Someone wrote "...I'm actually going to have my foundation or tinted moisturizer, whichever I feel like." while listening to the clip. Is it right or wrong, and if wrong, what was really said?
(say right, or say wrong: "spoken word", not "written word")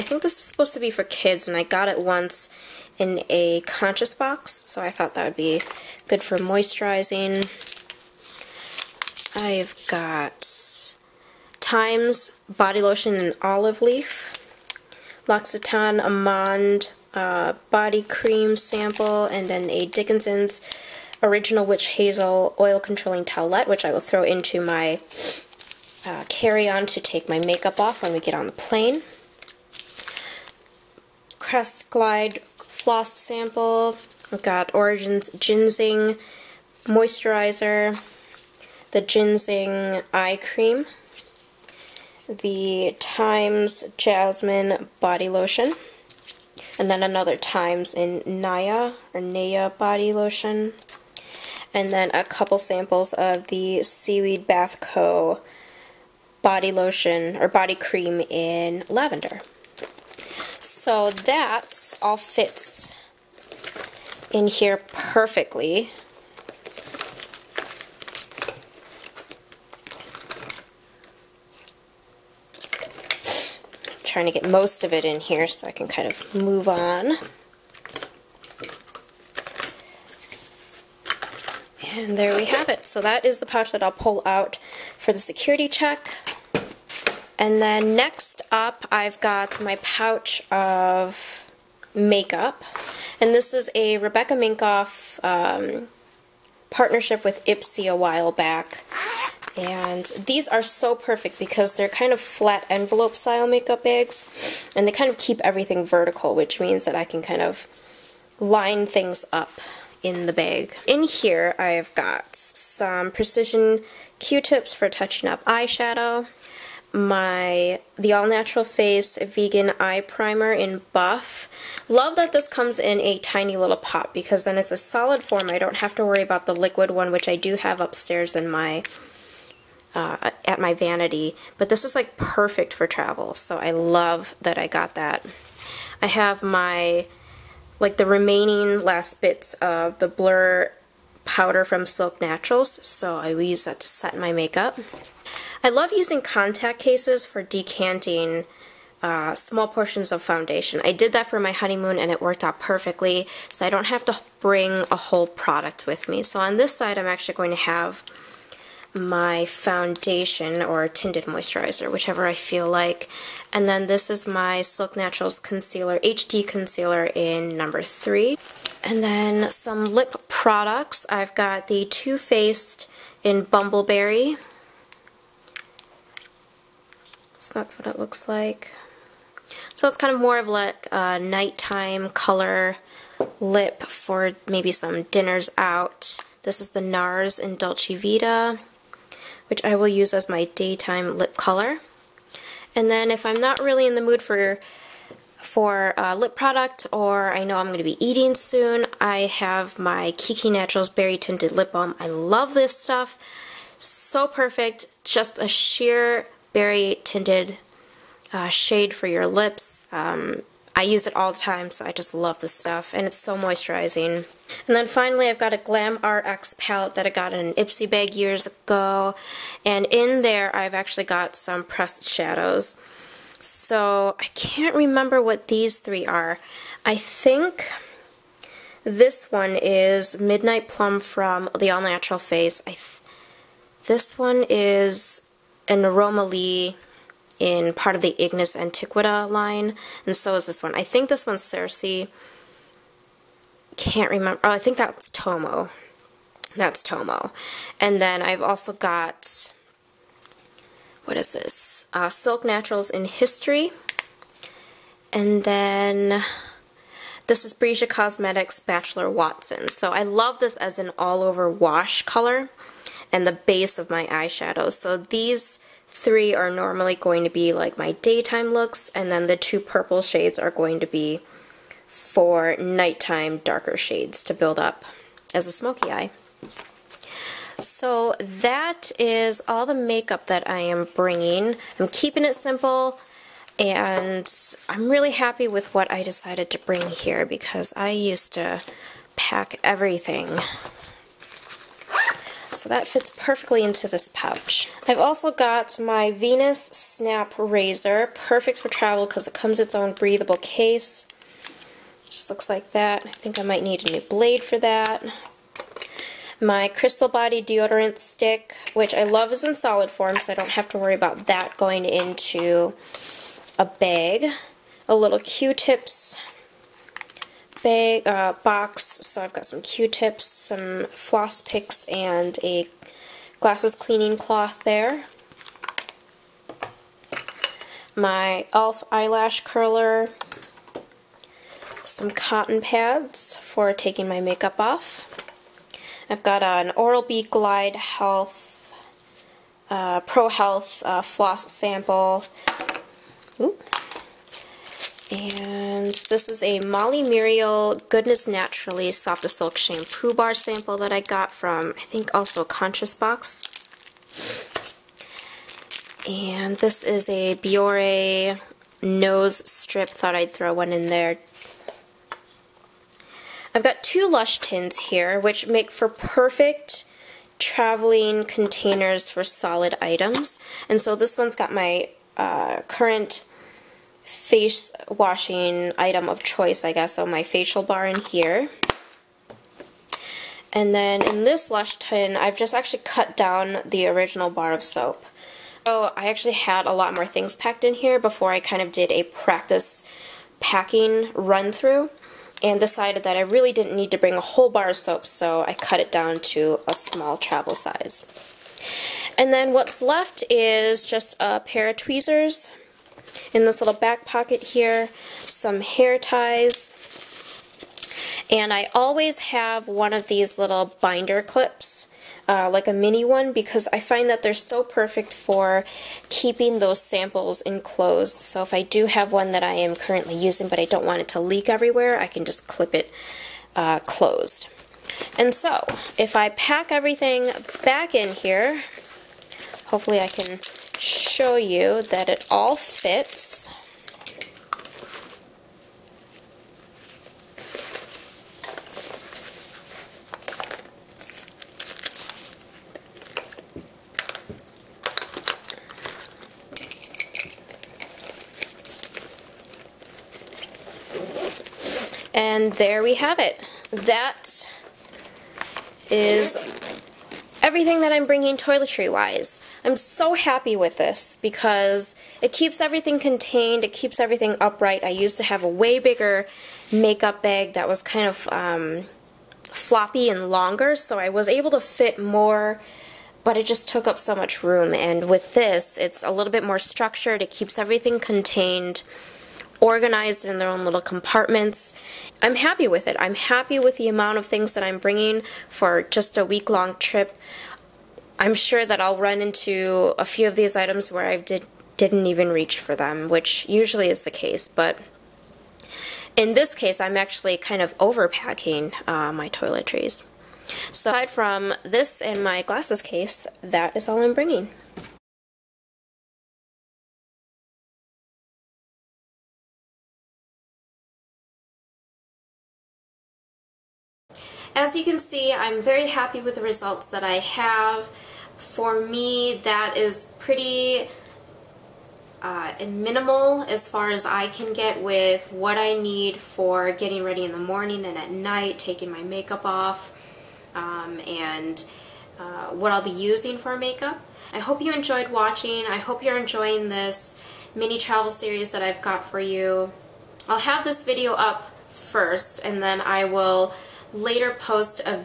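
right.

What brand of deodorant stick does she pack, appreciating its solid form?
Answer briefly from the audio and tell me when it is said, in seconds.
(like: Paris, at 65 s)
Crystal Body, at 306 s.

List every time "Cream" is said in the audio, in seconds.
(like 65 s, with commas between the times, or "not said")
18 s, 40 s, 57 s.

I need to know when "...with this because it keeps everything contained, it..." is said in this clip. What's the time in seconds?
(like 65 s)
460 s.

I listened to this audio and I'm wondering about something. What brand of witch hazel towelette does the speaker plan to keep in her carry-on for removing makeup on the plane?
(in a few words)
Dickinson's.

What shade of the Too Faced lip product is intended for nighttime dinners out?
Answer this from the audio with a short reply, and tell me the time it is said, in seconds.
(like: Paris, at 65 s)
Bumbleberry, at 173 s.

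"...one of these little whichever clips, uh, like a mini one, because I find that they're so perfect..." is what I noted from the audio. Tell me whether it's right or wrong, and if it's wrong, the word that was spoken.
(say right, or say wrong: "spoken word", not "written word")
wrong: "binder", not "whichever".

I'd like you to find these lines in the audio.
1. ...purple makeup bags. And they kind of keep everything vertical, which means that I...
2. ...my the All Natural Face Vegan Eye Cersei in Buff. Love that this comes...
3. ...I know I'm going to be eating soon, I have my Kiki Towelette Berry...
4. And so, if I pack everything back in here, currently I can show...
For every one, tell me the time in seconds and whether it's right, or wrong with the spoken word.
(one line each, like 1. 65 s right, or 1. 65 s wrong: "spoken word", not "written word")
1. 103 s wrong: "style", not "purple"
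2. 116 s wrong: "Primer", not "Cersei"
3. 197 s wrong: "Naturals", not "Towelette"
4. 425 s wrong: "hopefully", not "currently".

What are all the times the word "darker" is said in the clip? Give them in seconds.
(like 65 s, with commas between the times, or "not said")
273 s.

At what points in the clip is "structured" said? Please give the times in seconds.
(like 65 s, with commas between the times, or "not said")
476 s.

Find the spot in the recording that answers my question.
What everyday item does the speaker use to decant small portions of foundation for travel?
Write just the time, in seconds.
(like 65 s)
146 s.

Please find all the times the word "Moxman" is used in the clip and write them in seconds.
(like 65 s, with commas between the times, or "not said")
not said.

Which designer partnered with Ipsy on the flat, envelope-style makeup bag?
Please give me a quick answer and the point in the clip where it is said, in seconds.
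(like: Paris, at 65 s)
Rebecca Minkoff, at 93 s.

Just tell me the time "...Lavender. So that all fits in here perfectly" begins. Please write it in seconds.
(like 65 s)
58 s.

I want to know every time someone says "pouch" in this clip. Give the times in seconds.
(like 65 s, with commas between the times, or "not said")
83 s, 89 s, 294 s.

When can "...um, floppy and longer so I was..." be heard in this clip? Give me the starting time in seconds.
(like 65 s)
468 s.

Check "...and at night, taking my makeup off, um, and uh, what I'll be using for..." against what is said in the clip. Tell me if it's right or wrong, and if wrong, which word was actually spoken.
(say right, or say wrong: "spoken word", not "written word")
right.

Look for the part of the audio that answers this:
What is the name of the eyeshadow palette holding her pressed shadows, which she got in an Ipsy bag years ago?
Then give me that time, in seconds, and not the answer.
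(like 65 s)
215 s.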